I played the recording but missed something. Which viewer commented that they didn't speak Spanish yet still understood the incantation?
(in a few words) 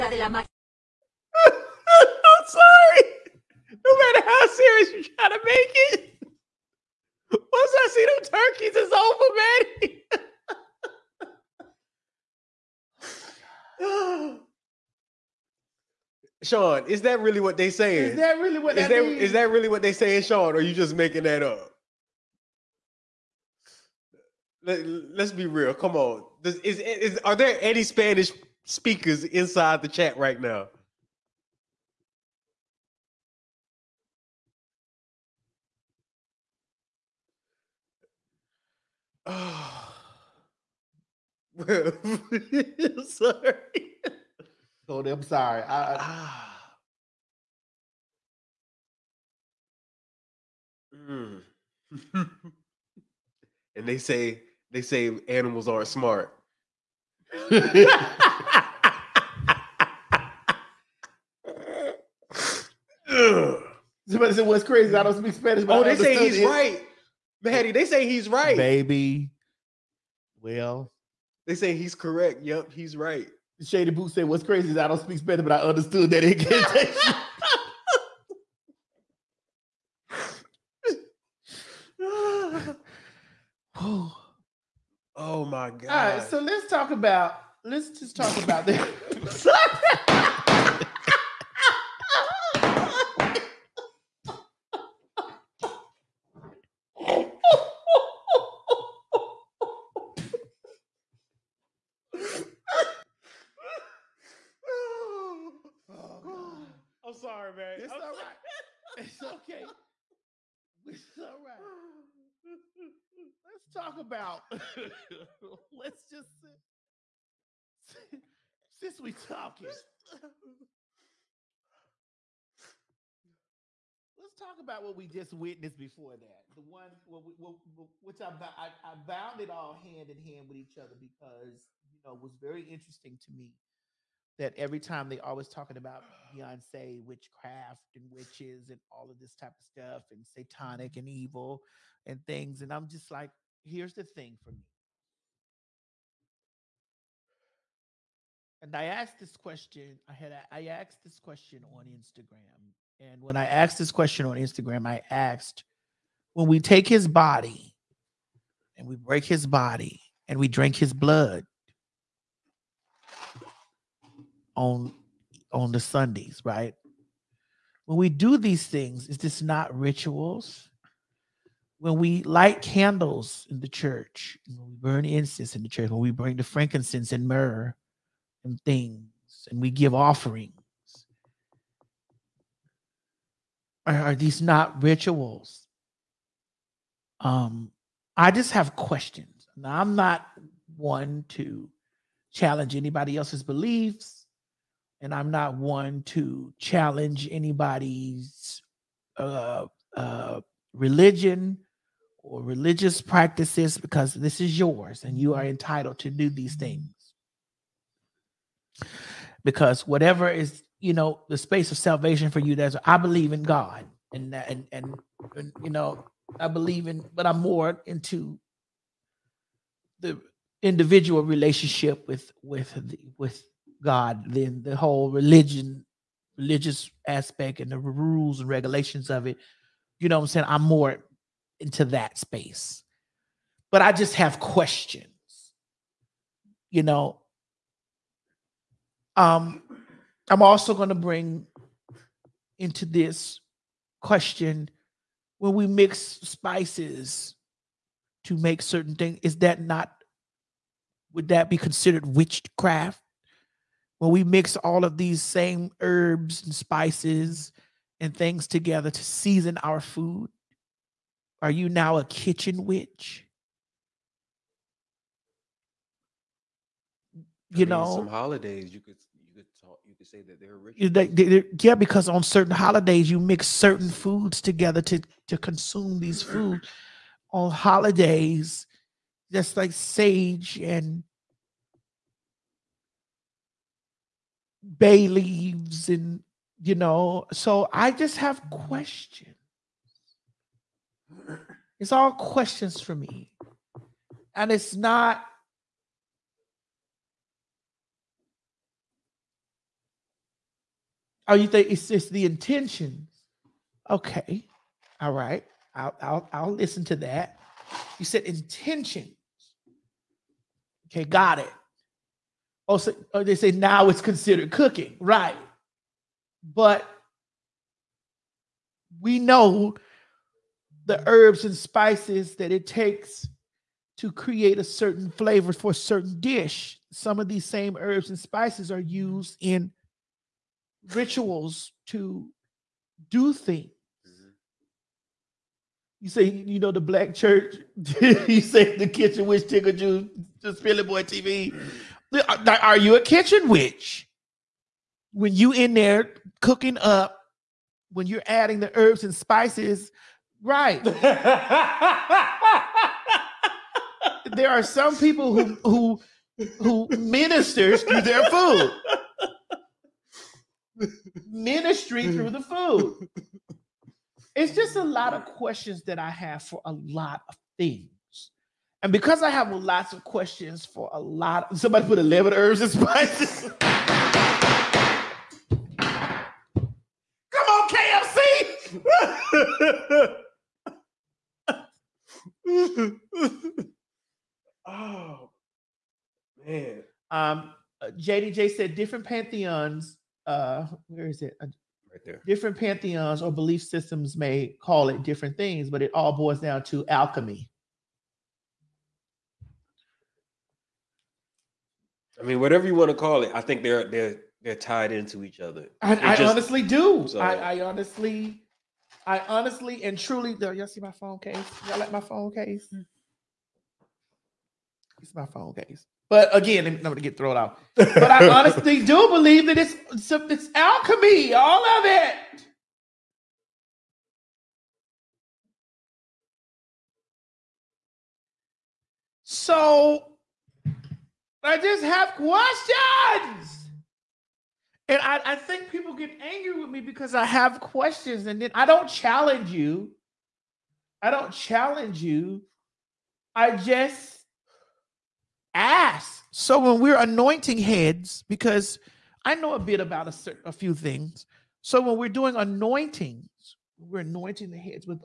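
Shady Boo.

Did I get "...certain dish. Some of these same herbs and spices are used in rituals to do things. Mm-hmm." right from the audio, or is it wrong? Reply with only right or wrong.
right.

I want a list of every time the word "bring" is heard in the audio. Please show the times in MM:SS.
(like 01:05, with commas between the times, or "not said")
02:56, 04:00.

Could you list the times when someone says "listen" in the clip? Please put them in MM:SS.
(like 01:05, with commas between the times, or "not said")
05:06.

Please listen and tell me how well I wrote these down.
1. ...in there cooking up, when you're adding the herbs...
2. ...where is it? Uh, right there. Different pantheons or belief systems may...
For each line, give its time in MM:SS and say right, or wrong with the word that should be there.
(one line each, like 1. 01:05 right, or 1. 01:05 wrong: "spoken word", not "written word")
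1. 05:45 right
2. 06:30 right.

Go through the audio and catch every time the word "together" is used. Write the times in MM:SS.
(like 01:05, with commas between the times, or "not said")
04:18, 04:34.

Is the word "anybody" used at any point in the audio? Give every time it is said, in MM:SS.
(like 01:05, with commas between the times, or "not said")
03:12, 03:17.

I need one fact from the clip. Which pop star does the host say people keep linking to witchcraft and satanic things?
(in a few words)
Beyonce.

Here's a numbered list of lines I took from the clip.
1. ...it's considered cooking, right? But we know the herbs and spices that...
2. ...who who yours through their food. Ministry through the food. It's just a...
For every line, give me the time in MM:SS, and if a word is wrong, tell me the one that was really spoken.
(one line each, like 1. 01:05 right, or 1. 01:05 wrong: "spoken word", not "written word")
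1. 05:13 right
2. 05:55 wrong: "ministers", not "yours".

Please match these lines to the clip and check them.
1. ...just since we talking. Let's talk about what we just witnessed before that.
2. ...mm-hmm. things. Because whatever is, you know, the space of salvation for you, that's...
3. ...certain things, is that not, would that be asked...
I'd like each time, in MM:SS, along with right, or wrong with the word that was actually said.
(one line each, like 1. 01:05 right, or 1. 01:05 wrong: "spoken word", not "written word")
1. 01:56 right
2. 03:26 right
3. 04:08 wrong: "considered", not "asked".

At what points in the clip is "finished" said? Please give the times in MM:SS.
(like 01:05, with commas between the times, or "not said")
not said.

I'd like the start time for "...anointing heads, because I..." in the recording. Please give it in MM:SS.
07:26.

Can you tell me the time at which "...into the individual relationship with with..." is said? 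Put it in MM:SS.
03:37.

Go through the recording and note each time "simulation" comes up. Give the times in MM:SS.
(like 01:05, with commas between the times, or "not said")
not said.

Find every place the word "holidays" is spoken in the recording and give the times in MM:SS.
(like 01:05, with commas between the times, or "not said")
04:28, 04:32, 04:37.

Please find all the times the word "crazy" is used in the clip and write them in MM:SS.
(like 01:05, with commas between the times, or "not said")
01:04, 01:14.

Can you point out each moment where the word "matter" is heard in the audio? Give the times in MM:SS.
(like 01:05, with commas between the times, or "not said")
00:04.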